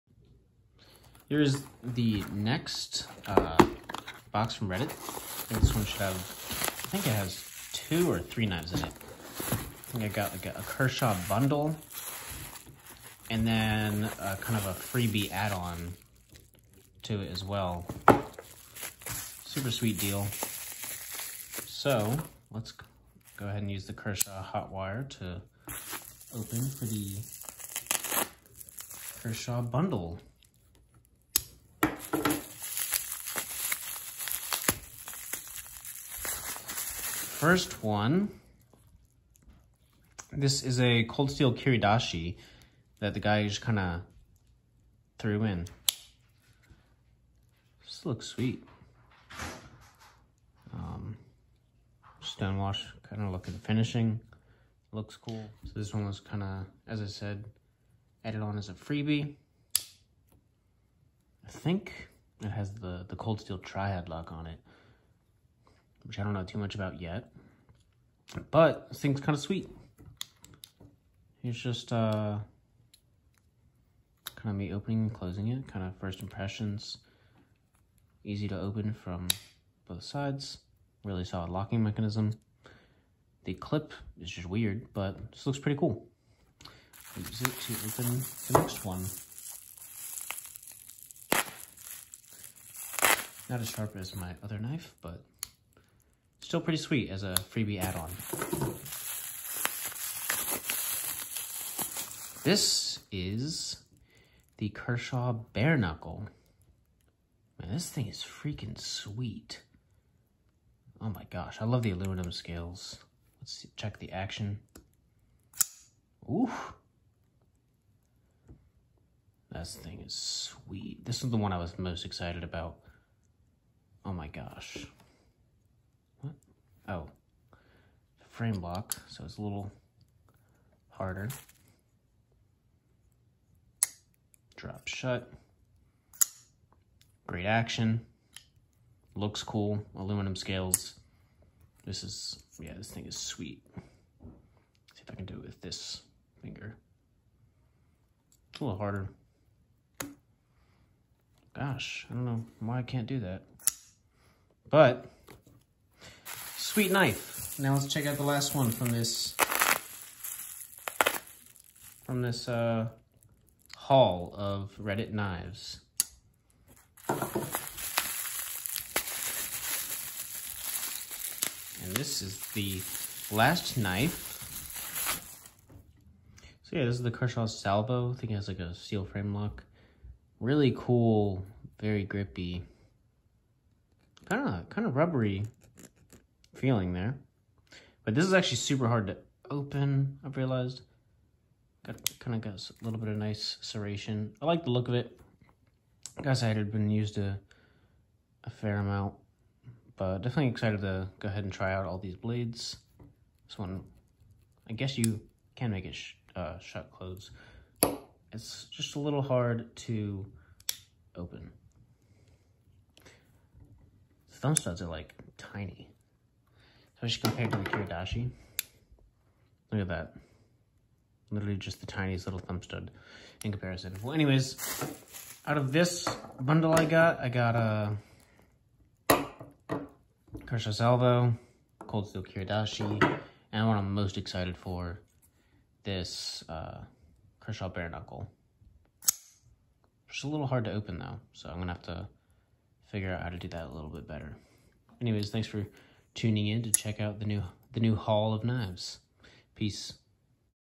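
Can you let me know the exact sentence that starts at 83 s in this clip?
The clip is just weird, but this looks pretty cool.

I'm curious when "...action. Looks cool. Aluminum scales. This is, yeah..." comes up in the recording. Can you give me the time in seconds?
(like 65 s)
137 s.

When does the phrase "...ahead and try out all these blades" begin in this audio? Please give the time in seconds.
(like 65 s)
201 s.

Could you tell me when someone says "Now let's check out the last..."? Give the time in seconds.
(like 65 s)
157 s.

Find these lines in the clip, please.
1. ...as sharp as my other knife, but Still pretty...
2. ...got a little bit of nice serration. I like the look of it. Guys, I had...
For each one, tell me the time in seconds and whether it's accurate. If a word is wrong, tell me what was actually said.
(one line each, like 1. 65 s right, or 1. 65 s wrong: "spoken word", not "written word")
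1. 93 s right
2. 192 s right.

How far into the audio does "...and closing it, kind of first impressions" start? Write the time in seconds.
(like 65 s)
75 s.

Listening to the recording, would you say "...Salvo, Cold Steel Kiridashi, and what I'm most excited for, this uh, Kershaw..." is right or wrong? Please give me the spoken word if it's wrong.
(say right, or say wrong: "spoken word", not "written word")
right.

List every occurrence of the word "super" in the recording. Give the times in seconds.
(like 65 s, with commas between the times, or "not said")
19 s, 188 s.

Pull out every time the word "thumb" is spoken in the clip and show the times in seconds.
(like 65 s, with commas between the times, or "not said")
214 s, 222 s.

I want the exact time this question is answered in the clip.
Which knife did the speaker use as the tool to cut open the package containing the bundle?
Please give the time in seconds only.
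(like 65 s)
23 s.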